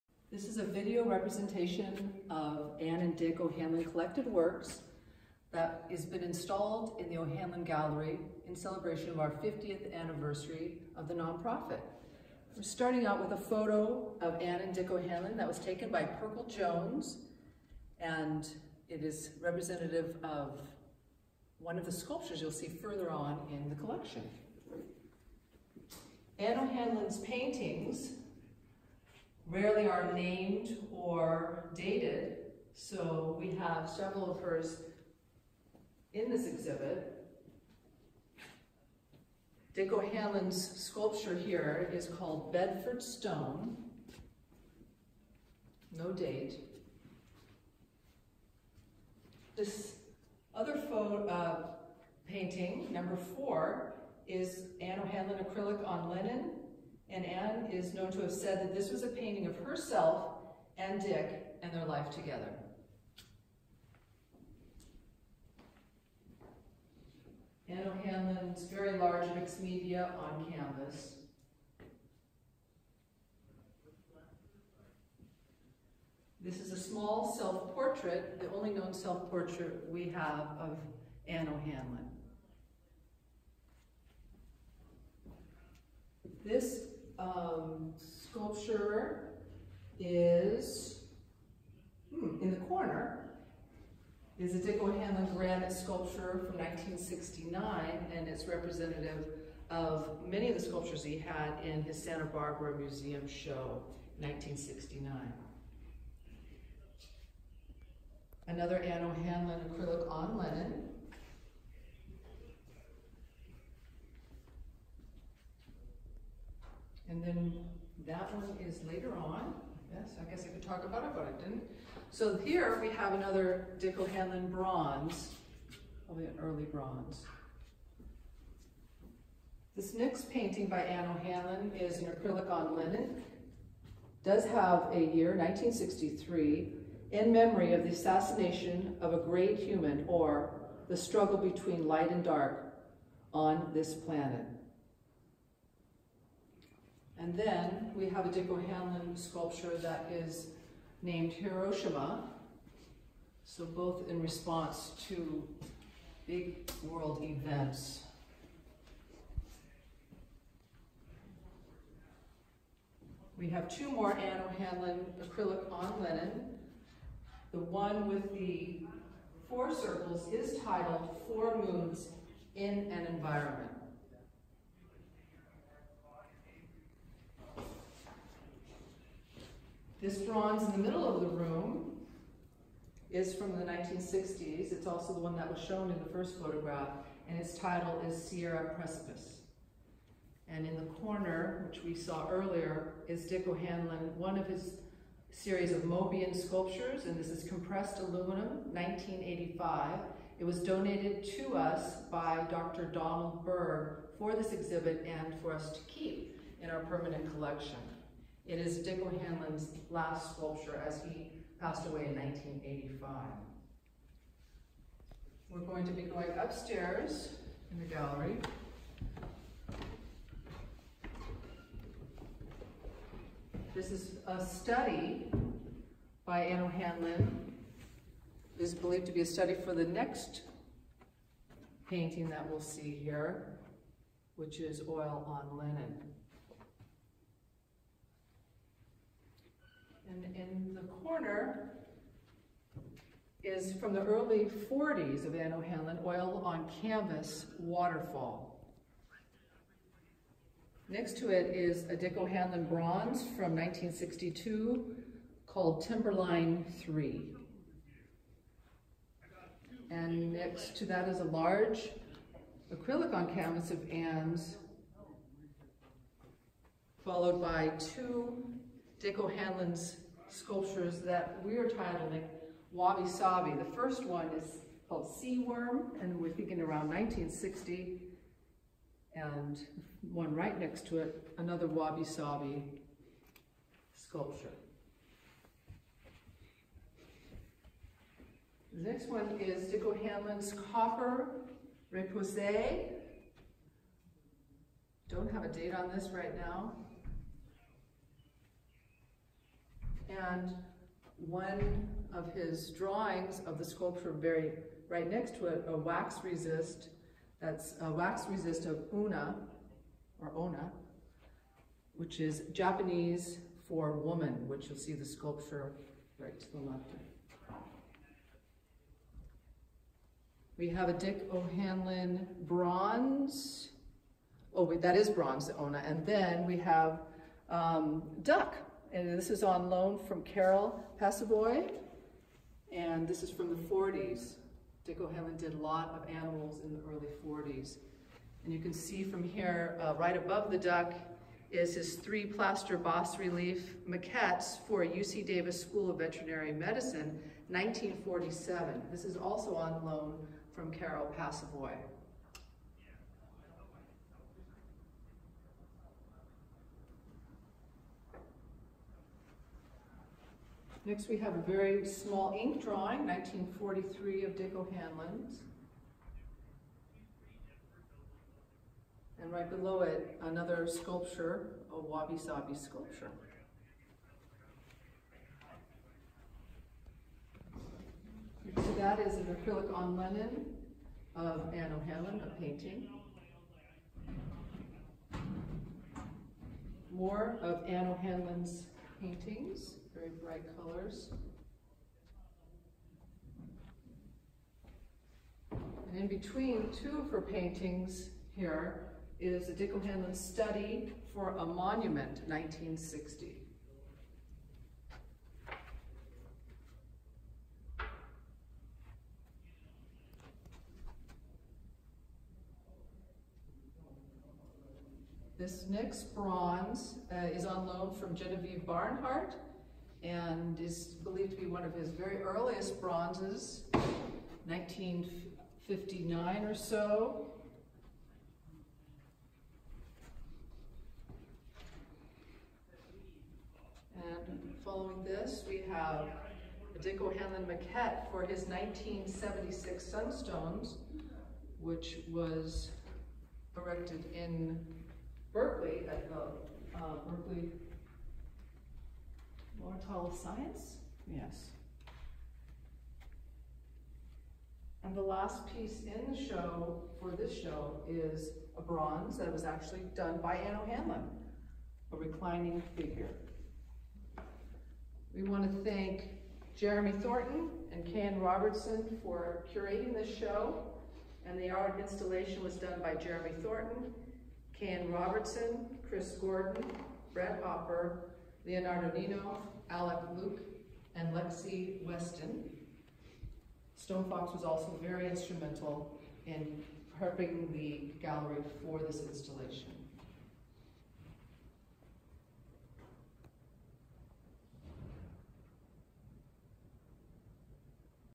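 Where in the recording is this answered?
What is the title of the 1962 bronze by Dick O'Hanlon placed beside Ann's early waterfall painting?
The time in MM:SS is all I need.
04:15.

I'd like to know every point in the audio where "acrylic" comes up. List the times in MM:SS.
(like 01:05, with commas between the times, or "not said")
00:55, 01:49, 02:12, 02:45, 04:22, 06:19.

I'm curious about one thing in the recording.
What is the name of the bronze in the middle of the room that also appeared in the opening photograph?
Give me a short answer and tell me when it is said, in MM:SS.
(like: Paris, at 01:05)
Sierra Precipice, at 03:08.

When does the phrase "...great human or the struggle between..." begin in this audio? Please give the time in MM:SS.
02:19.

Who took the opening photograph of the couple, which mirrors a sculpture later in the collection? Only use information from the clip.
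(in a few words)
Perkle Jones.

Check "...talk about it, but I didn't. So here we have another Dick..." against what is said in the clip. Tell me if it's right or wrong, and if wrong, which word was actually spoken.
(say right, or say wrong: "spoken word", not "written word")
right.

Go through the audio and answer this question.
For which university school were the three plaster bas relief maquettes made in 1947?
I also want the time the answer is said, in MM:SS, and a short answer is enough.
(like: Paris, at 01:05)
UC Davis School of Veterinary Medicine, at 05:44.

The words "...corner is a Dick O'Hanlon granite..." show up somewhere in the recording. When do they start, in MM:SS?
01:32.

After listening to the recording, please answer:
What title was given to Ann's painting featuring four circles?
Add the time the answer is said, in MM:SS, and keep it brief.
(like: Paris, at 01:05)
Four Moons in an Environment, at 02:51.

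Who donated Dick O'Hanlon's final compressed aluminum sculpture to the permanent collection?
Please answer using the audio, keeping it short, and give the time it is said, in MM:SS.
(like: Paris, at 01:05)
Dr. Donald Berg, at 03:22.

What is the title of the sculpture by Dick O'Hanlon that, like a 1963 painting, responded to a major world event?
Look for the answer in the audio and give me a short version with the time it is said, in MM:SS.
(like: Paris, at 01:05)
Hiroshima, at 02:31.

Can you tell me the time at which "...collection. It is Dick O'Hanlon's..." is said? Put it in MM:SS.
03:27.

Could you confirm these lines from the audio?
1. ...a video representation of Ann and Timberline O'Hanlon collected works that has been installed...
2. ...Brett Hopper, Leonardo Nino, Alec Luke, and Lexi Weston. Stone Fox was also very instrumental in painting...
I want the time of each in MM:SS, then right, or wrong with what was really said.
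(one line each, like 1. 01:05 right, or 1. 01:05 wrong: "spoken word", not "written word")
1. 00:00 wrong: "Dick", not "Timberline"
2. 07:57 wrong: "prepping", not "painting".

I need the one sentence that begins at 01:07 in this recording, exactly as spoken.
Ann O'Hanlon's very large mixed media on canvas.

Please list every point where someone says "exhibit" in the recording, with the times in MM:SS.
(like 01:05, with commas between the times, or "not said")
00:36, 03:24.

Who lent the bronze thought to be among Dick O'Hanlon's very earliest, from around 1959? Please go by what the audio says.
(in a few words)
Genevieve Barnhart.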